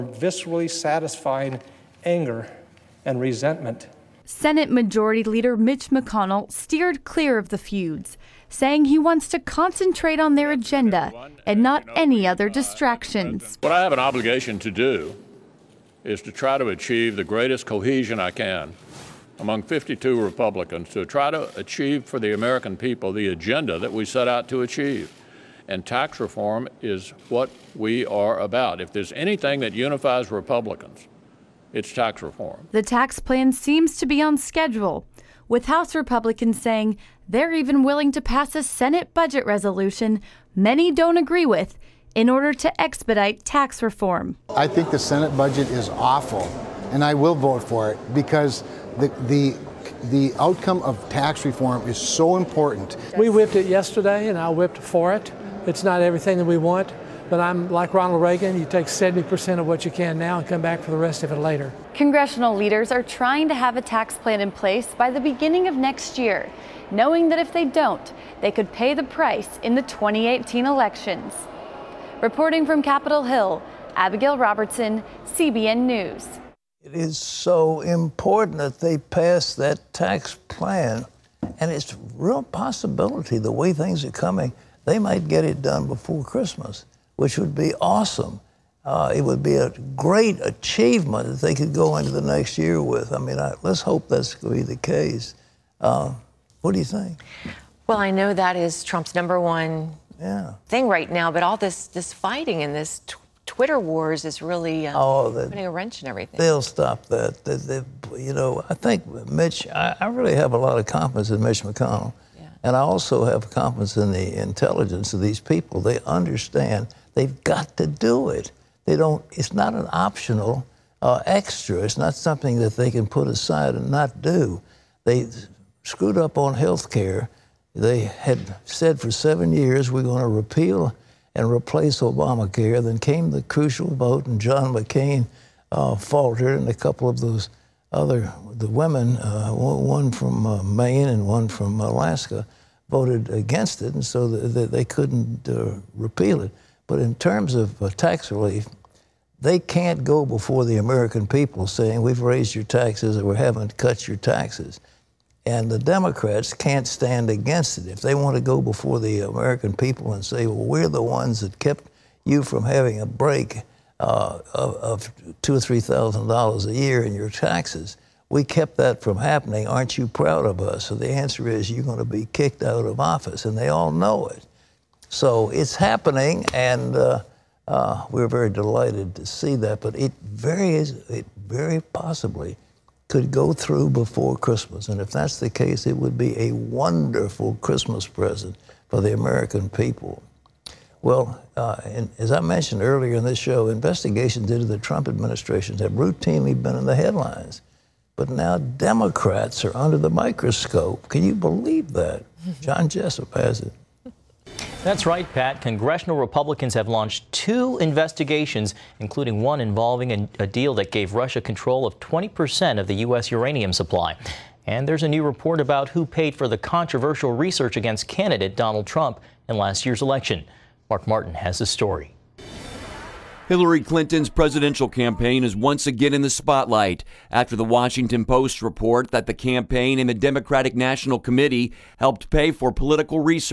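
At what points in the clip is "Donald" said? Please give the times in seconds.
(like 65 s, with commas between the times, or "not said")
218 s.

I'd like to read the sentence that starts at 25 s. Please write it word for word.
And tax reform is what we are about.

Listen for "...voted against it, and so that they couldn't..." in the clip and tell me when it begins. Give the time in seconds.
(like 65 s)
142 s.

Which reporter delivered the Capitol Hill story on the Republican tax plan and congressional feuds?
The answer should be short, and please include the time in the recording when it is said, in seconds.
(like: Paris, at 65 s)
Abigail Robertson, at 73 s.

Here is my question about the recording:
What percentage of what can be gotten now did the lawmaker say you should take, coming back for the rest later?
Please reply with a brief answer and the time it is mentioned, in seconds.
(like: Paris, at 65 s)
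70%, at 58 s.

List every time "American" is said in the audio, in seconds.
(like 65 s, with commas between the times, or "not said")
22 s, 150 s, 159 s, 189 s.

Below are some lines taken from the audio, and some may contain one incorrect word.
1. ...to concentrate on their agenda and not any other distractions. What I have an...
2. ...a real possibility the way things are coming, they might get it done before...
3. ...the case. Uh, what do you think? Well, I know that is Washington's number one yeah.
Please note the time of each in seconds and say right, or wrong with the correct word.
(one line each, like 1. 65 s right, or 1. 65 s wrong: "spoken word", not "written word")
1. 9 s right
2. 81 s right
3. 94 s wrong: "Trump", not "Washington".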